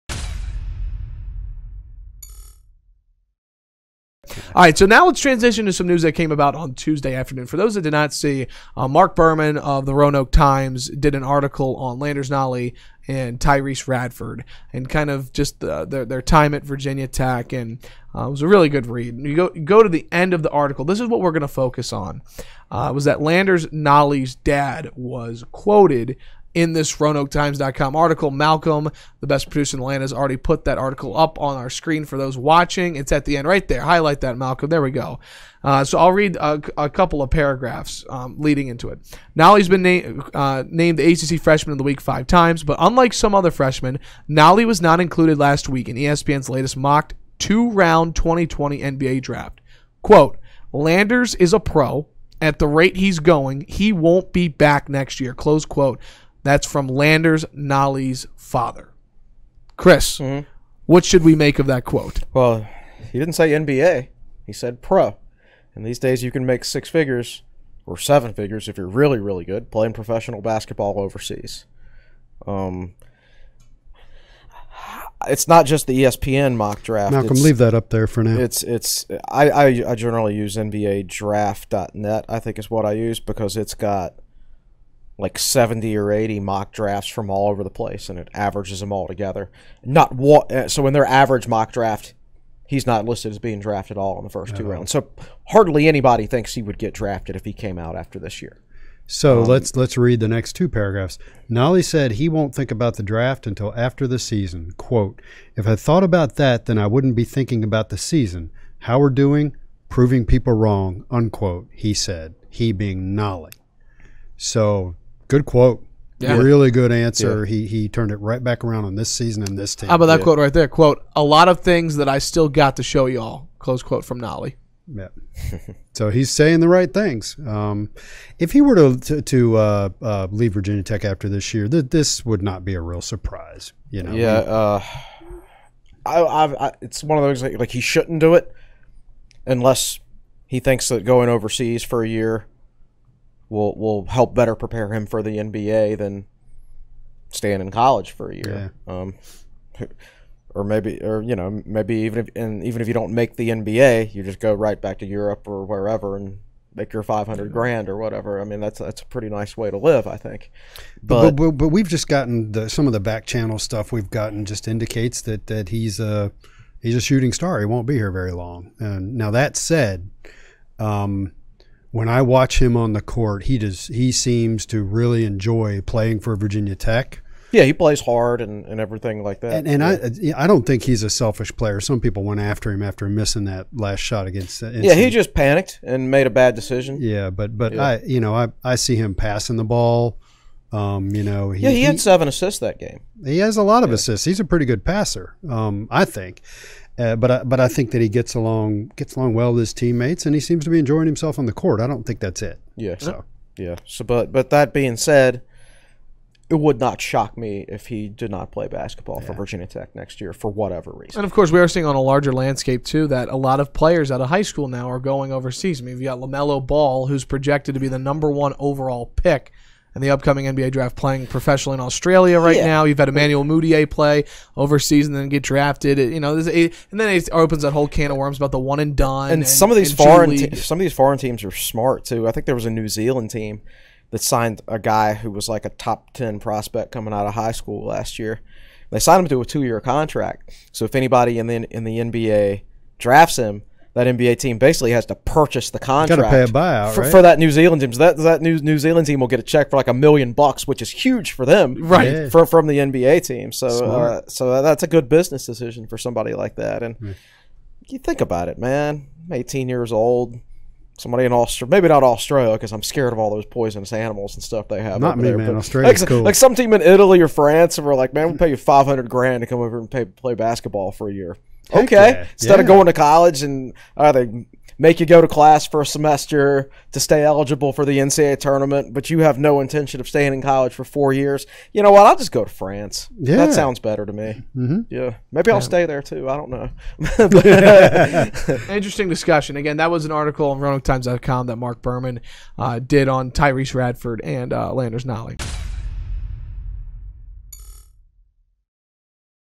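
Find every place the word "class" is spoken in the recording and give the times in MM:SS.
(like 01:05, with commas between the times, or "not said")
04:35.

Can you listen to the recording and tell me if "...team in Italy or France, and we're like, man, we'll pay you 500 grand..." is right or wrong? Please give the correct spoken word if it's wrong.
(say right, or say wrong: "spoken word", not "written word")
right.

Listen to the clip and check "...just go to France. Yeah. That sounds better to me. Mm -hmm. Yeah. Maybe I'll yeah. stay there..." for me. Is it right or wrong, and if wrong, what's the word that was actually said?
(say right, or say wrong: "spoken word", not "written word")
right.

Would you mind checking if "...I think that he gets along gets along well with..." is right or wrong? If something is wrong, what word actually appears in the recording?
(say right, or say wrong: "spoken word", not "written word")
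right.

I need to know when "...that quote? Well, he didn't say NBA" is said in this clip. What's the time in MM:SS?
01:01.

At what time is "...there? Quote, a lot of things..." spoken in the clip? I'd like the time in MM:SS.
02:00.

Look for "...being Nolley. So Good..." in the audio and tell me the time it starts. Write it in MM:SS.
01:52.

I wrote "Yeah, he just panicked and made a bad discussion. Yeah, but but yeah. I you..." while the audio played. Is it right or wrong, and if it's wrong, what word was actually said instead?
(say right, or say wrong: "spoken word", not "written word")
wrong: "decision", not "discussion".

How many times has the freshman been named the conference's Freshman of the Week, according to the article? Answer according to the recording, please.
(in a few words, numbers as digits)
5.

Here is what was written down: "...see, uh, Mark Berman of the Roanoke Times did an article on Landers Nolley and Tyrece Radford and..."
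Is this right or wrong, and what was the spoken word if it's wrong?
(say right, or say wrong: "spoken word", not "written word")
right.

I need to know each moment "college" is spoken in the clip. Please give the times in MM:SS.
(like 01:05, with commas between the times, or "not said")
02:27, 04:32, 04:40.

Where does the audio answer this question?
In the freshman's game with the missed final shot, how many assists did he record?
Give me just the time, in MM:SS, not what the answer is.
03:11.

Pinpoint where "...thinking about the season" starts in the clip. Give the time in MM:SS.
01:47.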